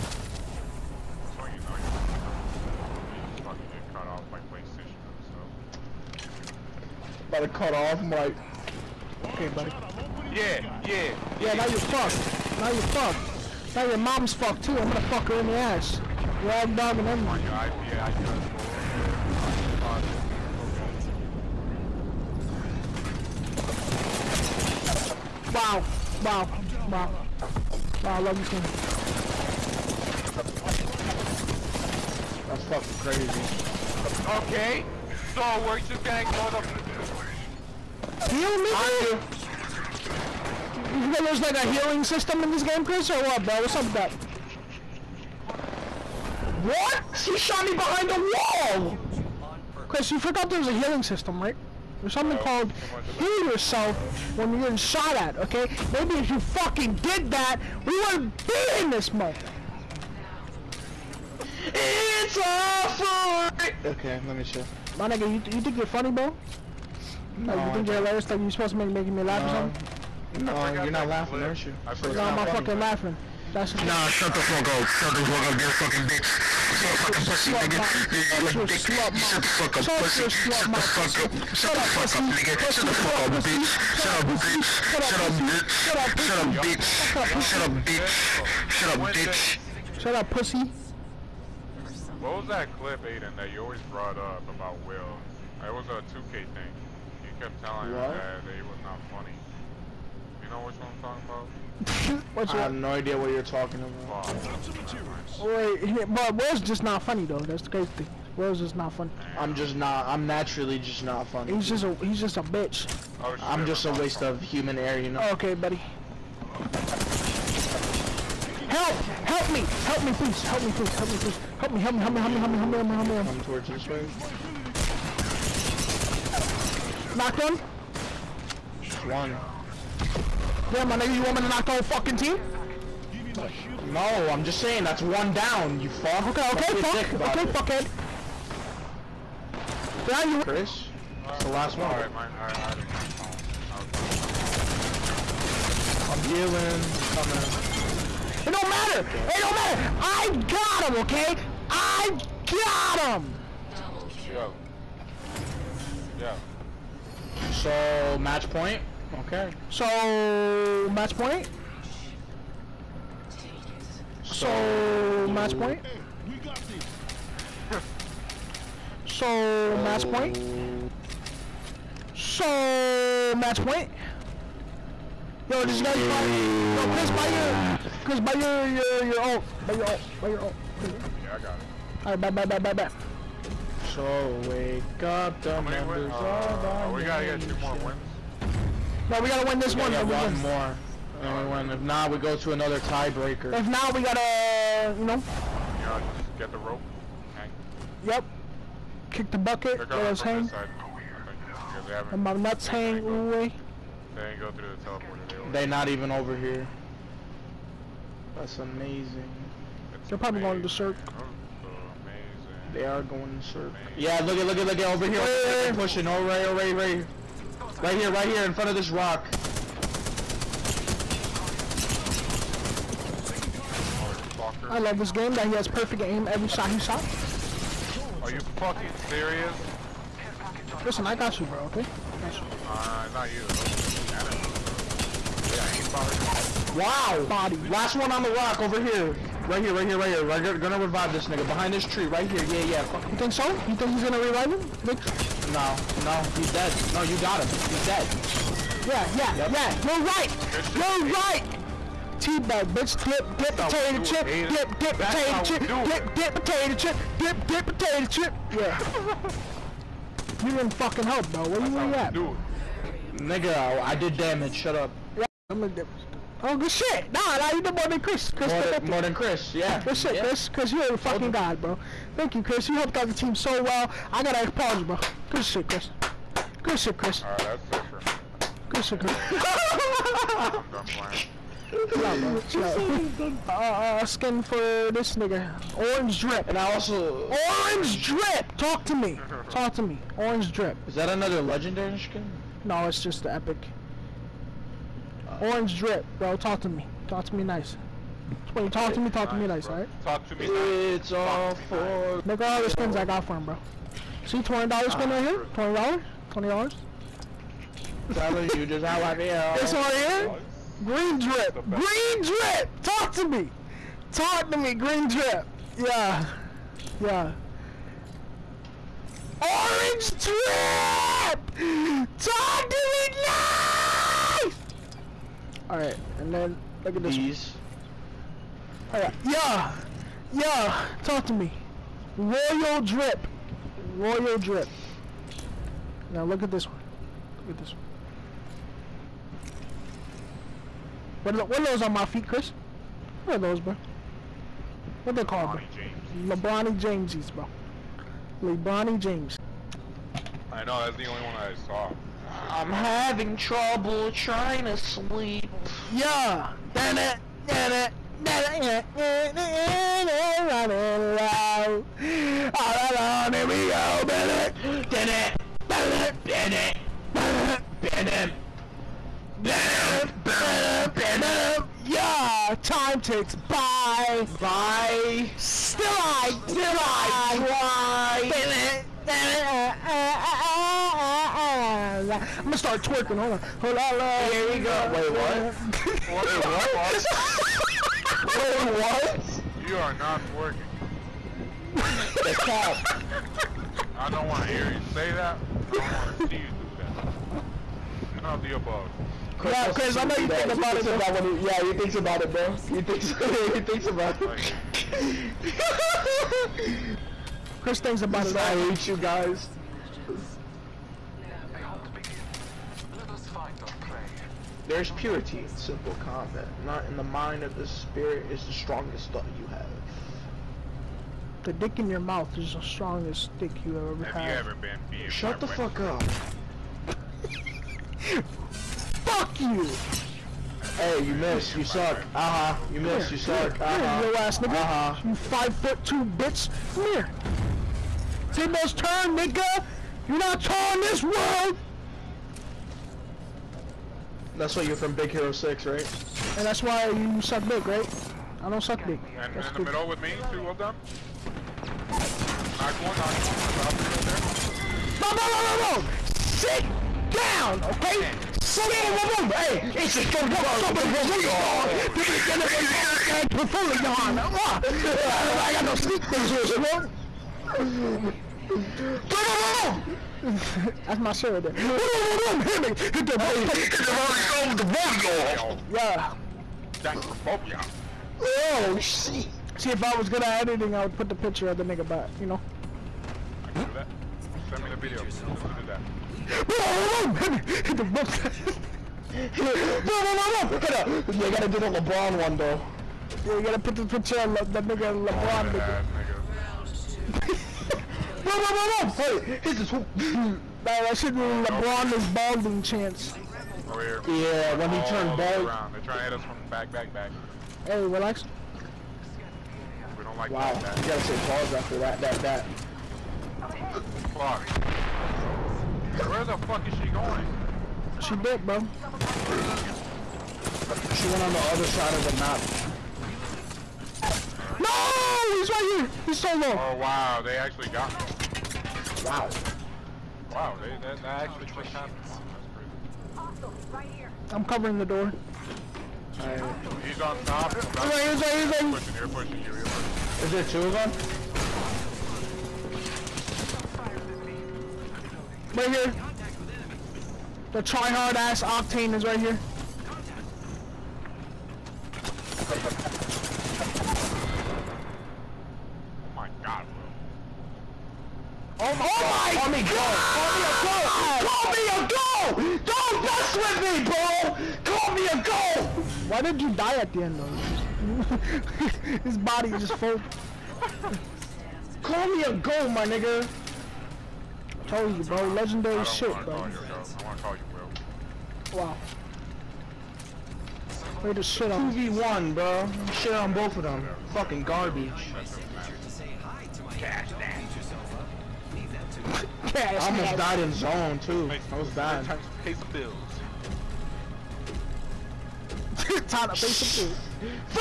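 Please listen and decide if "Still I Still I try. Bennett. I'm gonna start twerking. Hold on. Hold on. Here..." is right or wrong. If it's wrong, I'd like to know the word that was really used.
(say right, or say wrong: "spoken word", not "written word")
right.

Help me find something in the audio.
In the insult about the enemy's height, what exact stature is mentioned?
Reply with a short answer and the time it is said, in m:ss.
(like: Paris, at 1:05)
Five foot two, at 7:15.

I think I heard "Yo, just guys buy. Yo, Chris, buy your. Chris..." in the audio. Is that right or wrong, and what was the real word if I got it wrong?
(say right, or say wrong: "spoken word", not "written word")
right.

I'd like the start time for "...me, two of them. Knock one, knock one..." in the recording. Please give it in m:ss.
7:30.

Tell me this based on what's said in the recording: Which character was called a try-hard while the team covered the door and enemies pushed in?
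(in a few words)
Octane.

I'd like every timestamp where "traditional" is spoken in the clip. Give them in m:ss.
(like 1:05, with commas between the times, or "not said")
not said.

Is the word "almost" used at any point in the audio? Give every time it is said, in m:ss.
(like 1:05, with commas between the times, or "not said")
9:49.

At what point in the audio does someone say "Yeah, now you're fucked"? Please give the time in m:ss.
0:11.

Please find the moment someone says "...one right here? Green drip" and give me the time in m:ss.
5:09.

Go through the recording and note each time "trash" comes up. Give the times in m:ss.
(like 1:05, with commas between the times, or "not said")
9:49.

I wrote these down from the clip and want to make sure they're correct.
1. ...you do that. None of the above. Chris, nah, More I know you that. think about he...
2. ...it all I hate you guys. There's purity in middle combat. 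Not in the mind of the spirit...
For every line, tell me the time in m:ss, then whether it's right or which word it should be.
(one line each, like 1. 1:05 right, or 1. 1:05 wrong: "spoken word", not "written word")
1. 6:36 wrong: "Chris", not "More"
2. 6:48 wrong: "simple", not "middle".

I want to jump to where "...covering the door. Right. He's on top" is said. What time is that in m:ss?
8:54.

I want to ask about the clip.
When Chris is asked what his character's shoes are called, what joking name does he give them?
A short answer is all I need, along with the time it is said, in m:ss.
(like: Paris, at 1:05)
LeBronny Jamesies, at 5:46.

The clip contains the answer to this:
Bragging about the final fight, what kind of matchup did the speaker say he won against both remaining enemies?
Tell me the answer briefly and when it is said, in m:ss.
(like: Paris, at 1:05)
2v1, at 9:41.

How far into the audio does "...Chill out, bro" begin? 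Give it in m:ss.
4:41.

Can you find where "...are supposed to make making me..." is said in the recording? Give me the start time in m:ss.
1:08.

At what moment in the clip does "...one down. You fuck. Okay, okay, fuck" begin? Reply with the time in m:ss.
2:15.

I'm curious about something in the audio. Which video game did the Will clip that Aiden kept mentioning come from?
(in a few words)
2K.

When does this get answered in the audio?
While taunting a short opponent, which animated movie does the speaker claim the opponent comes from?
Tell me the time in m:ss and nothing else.
7:24.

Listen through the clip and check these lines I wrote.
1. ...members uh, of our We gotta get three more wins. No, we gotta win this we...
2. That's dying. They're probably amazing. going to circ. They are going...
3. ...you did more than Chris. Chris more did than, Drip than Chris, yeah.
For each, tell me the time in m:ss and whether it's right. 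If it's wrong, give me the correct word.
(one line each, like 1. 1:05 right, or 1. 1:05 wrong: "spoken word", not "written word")
1. 3:05 wrong: "two", not "three"
2. 3:28 wrong: "amazing", not "dying"
3. 4:27 wrong: "More", not "Drip".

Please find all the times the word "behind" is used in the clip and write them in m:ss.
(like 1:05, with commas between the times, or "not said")
0:38, 0:47, 4:01.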